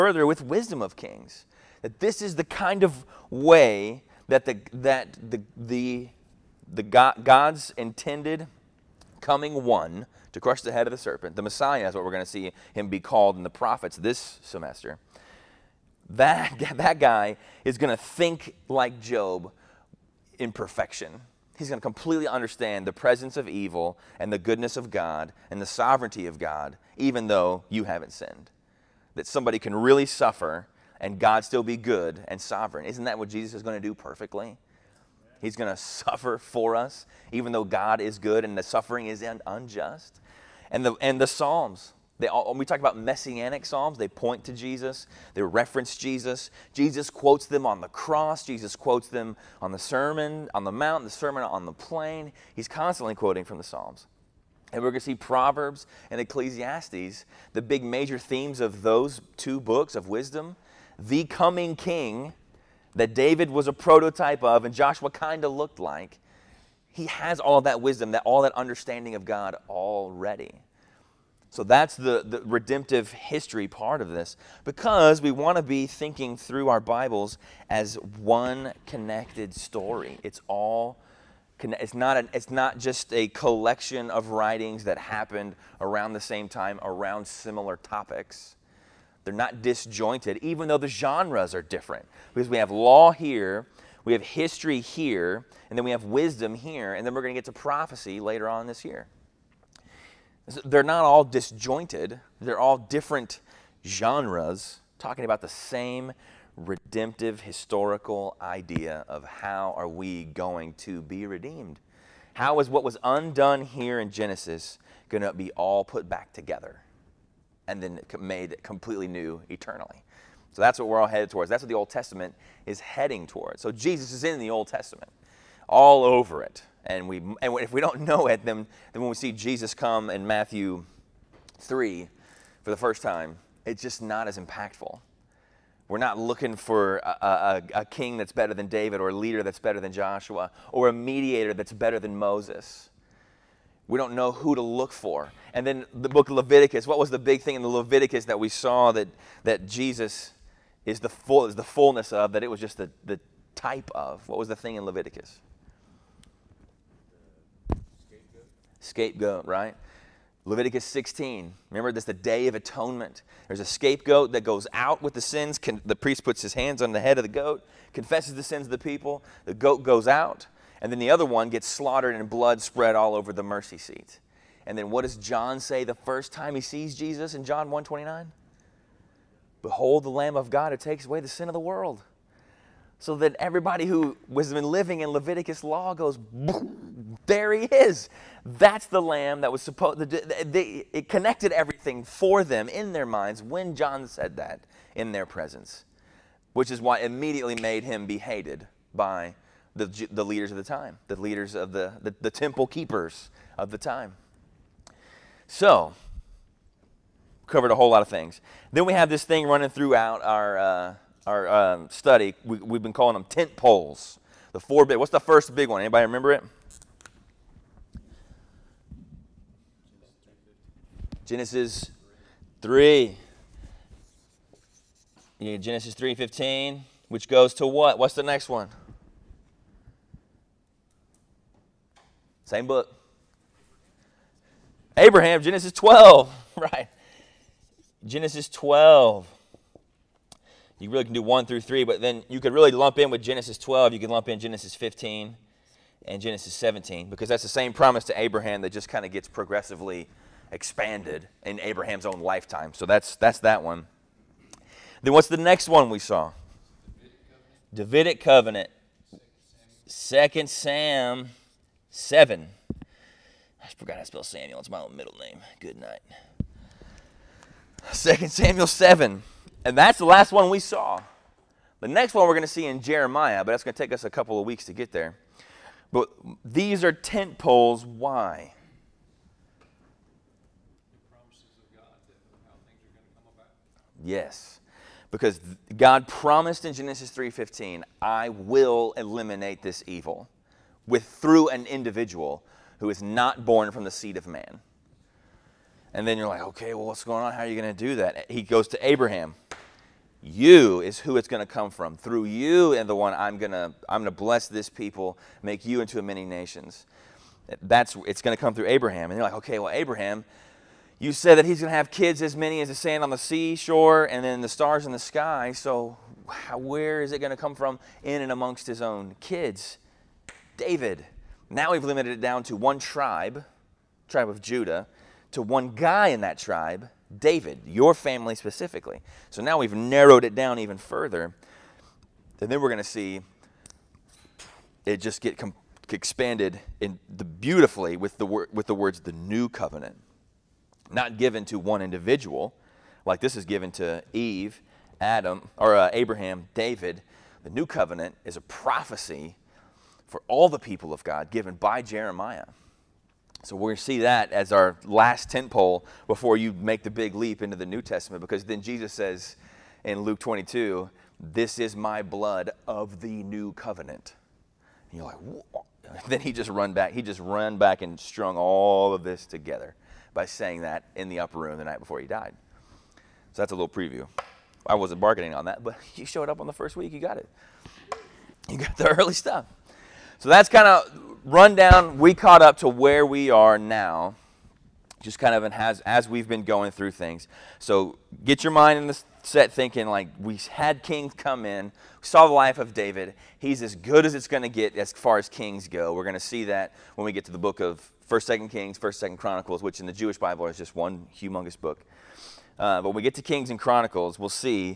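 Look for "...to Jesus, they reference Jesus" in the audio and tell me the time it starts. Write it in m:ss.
0:44.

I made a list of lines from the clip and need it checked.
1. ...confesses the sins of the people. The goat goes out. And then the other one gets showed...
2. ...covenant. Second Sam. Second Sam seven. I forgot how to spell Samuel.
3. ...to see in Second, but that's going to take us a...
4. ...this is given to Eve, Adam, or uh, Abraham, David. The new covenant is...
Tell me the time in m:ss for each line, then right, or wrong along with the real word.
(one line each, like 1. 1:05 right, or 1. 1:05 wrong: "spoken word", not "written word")
1. 2:47 wrong: "slaughtered", not "showed"
2. 4:18 right
3. 4:32 wrong: "Jeremiah", not "Second"
4. 5:43 right.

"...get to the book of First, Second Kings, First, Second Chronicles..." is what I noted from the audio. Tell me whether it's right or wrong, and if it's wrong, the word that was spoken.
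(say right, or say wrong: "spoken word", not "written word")
right.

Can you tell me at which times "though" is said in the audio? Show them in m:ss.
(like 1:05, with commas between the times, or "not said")
0:27, 0:37, 1:30.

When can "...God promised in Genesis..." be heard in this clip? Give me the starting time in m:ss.
4:45.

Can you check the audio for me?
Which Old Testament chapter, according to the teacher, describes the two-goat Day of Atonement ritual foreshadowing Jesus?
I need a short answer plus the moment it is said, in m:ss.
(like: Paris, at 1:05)
Leviticus 16, at 2:40.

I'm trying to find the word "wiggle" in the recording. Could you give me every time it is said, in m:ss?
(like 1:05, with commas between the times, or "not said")
not said.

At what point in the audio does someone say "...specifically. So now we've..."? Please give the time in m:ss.
5:28.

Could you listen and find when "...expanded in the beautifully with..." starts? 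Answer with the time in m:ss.
5:35.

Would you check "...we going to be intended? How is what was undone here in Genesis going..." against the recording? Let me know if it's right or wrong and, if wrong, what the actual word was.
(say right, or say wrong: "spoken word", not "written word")
wrong: "redeemed", not "intended".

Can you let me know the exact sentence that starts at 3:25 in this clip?
So, covered a whole lot of things.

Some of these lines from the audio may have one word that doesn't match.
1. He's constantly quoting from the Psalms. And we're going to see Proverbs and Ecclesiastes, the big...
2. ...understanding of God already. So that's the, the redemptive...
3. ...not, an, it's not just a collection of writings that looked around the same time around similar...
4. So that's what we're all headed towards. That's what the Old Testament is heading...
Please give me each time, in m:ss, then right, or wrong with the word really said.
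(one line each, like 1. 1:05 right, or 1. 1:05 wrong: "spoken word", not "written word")
1. 0:52 right
2. 1:08 right
3. 1:21 wrong: "happened", not "looked"
4. 2:00 right.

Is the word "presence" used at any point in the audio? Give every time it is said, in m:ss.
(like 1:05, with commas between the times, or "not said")
0:22, 3:15.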